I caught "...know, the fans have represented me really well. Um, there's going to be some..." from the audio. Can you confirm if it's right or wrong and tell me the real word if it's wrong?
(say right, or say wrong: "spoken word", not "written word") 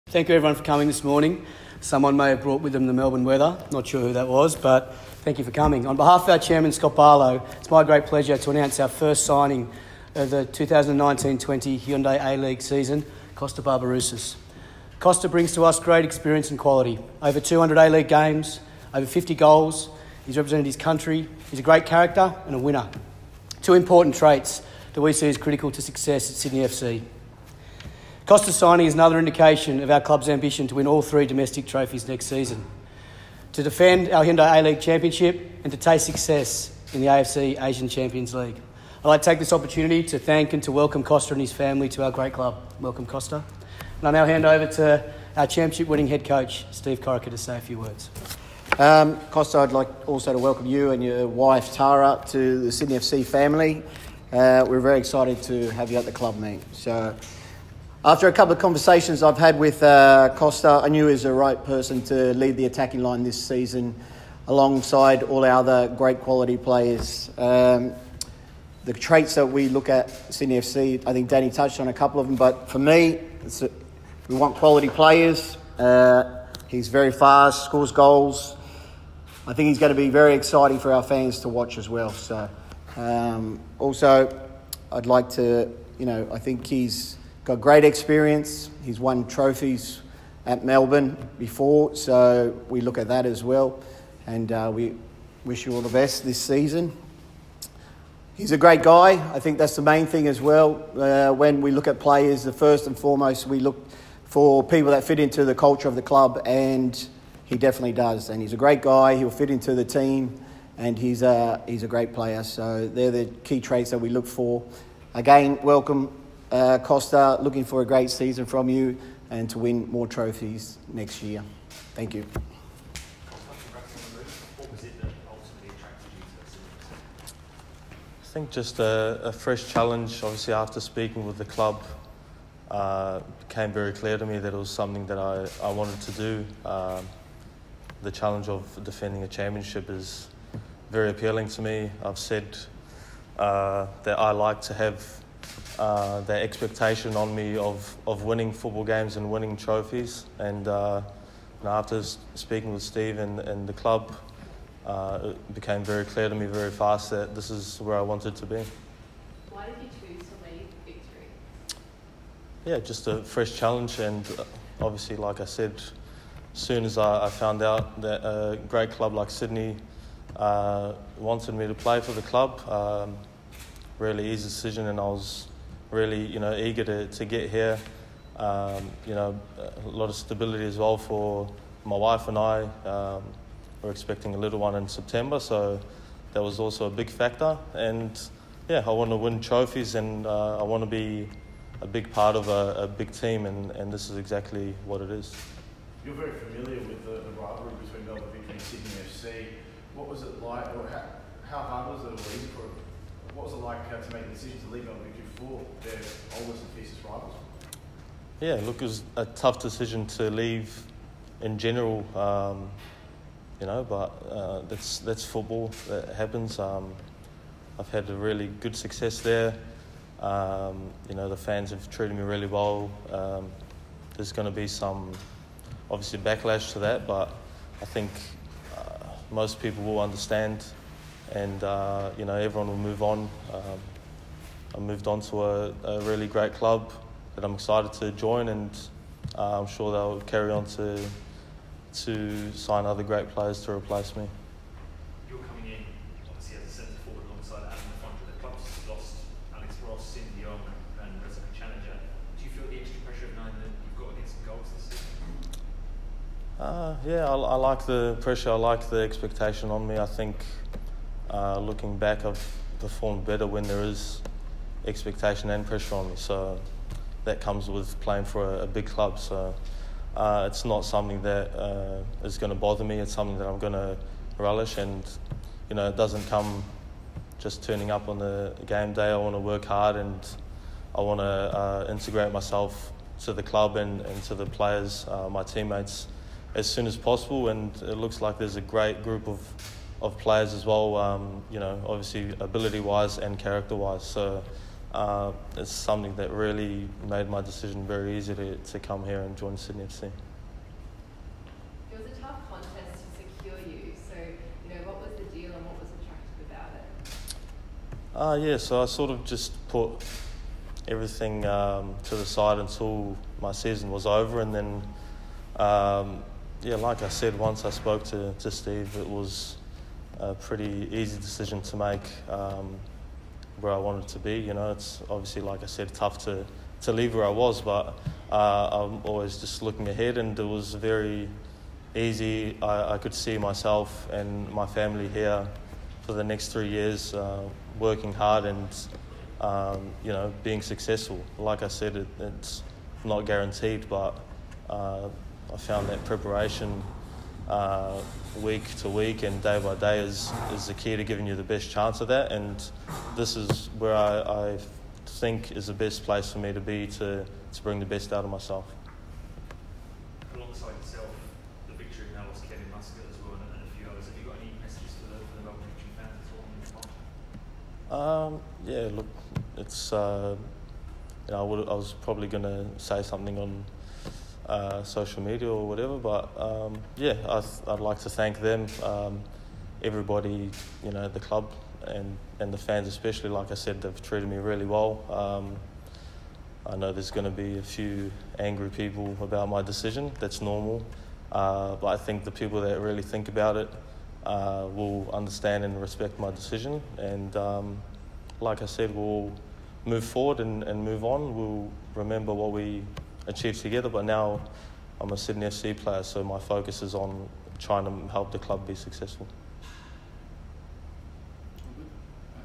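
wrong: "treated", not "represented".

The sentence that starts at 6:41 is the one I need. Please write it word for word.
We'll remember what we achieved together.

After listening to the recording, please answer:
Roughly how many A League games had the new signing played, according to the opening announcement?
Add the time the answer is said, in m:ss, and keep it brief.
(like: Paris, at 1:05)
Over 200, at 0:17.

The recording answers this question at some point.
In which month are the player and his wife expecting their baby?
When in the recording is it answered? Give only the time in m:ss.
3:04.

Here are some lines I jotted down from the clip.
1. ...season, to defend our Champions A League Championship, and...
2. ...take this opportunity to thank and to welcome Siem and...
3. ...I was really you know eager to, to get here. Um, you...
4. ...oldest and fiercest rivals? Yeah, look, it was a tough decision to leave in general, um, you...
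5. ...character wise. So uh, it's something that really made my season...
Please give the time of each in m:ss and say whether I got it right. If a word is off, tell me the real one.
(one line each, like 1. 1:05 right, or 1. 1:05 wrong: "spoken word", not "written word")
1. 0:32 wrong: "Hyundai", not "Champions"
2. 0:39 wrong: "Kosta", not "Siem"
3. 2:54 right
4. 3:26 right
5. 4:53 wrong: "decision", not "season".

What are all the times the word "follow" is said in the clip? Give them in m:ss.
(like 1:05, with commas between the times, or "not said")
not said.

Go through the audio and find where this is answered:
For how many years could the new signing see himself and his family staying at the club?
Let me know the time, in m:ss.
5:36.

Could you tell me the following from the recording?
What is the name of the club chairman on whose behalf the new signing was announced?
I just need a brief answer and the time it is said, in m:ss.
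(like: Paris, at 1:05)
Scott Barlow, at 0:06.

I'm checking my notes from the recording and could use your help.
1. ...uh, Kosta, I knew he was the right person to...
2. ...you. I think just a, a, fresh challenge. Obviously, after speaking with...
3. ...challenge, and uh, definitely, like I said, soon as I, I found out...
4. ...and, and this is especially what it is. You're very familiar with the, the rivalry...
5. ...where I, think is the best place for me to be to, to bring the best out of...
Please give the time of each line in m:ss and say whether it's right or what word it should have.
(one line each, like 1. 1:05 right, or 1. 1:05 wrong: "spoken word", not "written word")
1. 0:59 right
2. 2:02 right
3. 2:43 wrong: "obviously", not "definitely"
4. 3:13 wrong: "exactly", not "especially"
5. 5:53 right.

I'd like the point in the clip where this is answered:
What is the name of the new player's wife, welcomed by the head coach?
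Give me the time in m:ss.
0:51.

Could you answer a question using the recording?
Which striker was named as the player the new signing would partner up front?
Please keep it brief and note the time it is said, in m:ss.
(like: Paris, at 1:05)
Adam Fonda, at 4:07.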